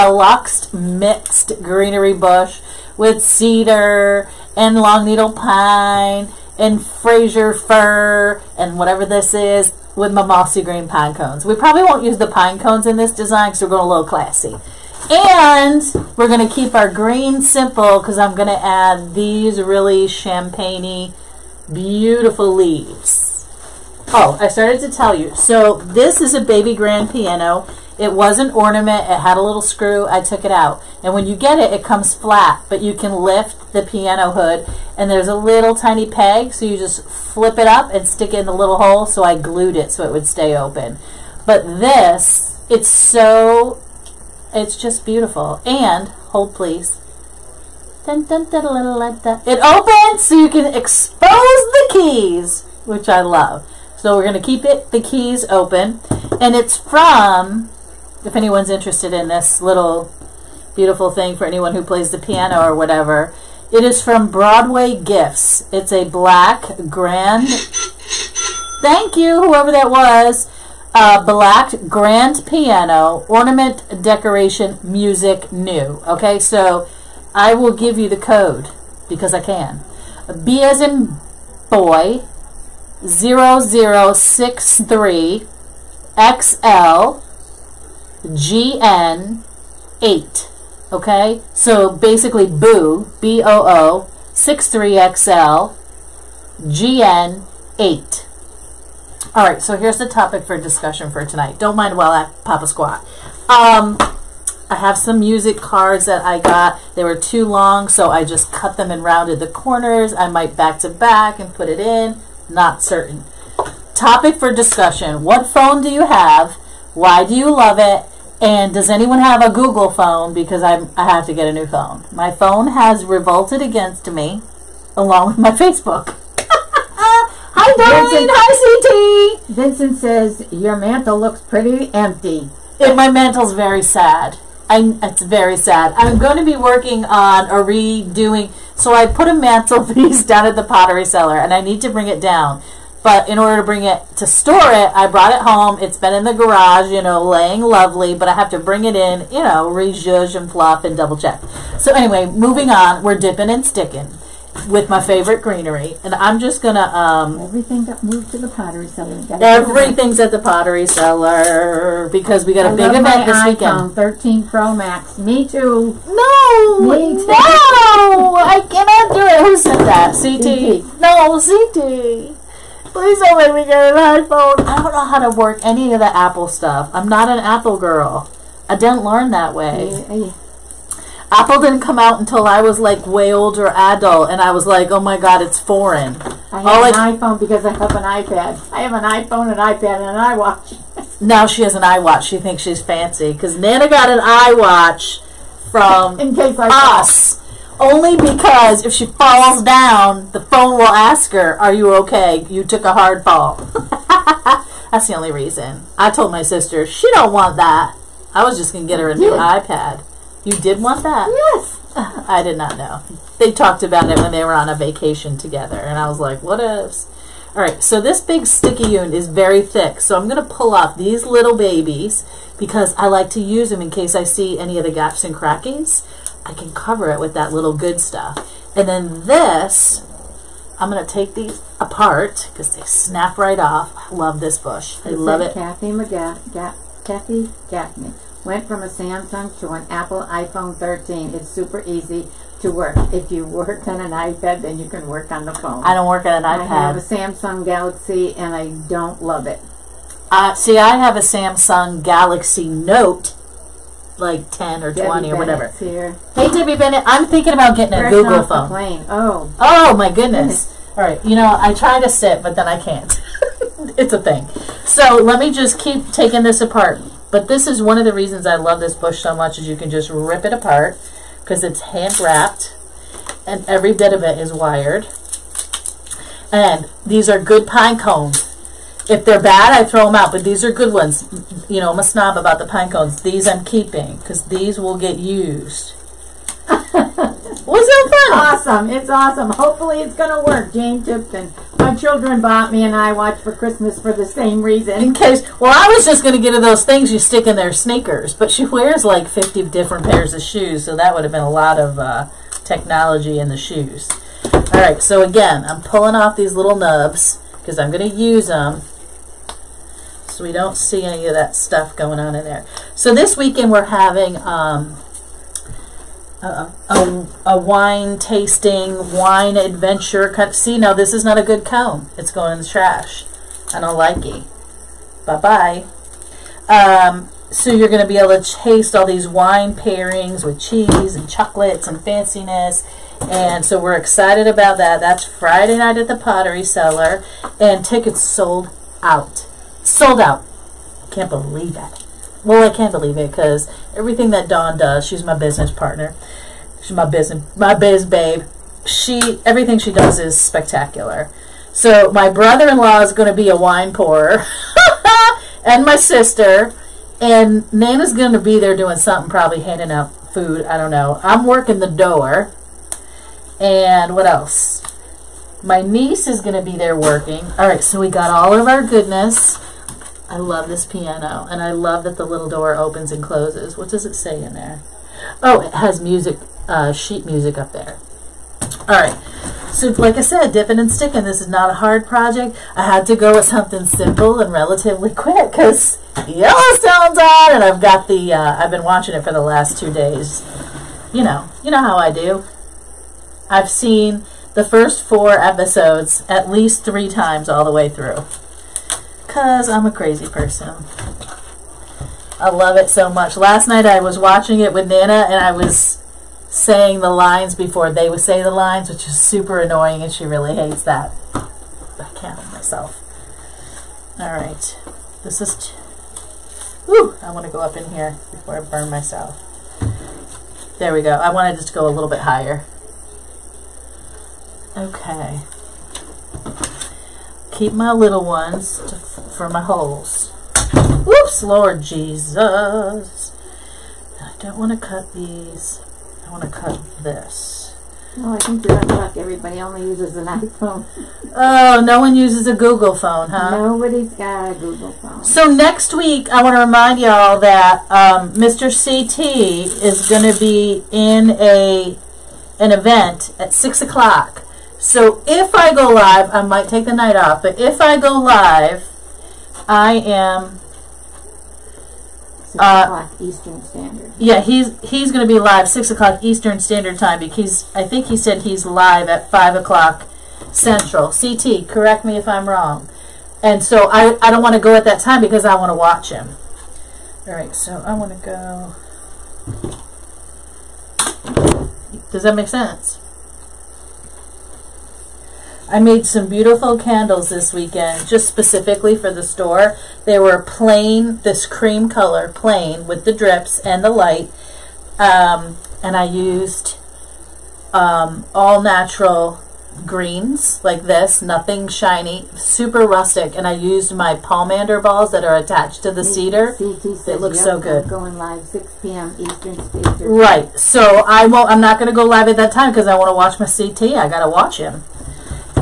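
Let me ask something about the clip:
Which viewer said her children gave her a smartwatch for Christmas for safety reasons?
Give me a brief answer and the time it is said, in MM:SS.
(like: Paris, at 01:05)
Jane Tipton, at 04:50.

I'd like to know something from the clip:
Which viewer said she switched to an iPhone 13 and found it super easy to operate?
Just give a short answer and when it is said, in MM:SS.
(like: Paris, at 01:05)
Kathy Gaffney, at 03:57.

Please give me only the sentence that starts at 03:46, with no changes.
I can cover it with that little good stuff.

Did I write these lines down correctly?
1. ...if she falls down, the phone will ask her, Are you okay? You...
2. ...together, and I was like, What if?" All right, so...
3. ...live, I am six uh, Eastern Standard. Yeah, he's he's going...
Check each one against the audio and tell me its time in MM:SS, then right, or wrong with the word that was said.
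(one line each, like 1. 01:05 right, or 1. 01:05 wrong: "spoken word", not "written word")
1. 03:18 right
2. 03:35 right
3. 07:38 right.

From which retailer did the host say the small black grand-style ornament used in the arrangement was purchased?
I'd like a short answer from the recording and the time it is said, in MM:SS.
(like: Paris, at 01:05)
Broadway Gifts, at 01:04.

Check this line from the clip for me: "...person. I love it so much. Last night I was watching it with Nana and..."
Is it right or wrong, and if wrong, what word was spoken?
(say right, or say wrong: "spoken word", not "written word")
right.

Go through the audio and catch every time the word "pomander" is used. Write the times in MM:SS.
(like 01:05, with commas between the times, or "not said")
08:24.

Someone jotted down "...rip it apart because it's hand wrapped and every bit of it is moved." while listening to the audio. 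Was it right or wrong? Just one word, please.
wrong.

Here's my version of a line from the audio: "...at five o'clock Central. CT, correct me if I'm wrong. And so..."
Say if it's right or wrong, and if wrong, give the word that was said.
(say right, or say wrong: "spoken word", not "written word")
right.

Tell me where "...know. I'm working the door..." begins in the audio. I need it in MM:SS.
06:00.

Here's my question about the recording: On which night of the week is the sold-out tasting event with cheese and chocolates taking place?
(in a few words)
Friday.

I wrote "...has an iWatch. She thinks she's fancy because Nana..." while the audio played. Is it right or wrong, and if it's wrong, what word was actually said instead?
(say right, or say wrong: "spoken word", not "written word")
right.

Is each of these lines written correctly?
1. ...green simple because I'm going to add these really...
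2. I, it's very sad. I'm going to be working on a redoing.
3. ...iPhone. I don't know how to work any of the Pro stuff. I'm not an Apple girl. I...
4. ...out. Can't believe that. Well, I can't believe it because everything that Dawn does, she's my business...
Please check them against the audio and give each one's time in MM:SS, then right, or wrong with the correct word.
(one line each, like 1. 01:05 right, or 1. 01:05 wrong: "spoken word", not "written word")
1. 00:16 right
2. 02:14 right
3. 02:54 wrong: "Apple", not "Pro"
4. 05:40 right.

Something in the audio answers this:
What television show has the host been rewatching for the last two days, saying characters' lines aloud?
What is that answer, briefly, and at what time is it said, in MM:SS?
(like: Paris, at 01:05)
Yellowstone, at 06:26.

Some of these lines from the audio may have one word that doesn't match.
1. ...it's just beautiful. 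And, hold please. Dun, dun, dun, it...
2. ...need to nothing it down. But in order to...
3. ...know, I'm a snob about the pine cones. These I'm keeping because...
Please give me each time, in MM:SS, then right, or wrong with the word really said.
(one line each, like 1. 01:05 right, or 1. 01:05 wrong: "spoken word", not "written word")
1. 00:44 right
2. 02:21 wrong: "bring", not "nothing"
3. 04:41 right.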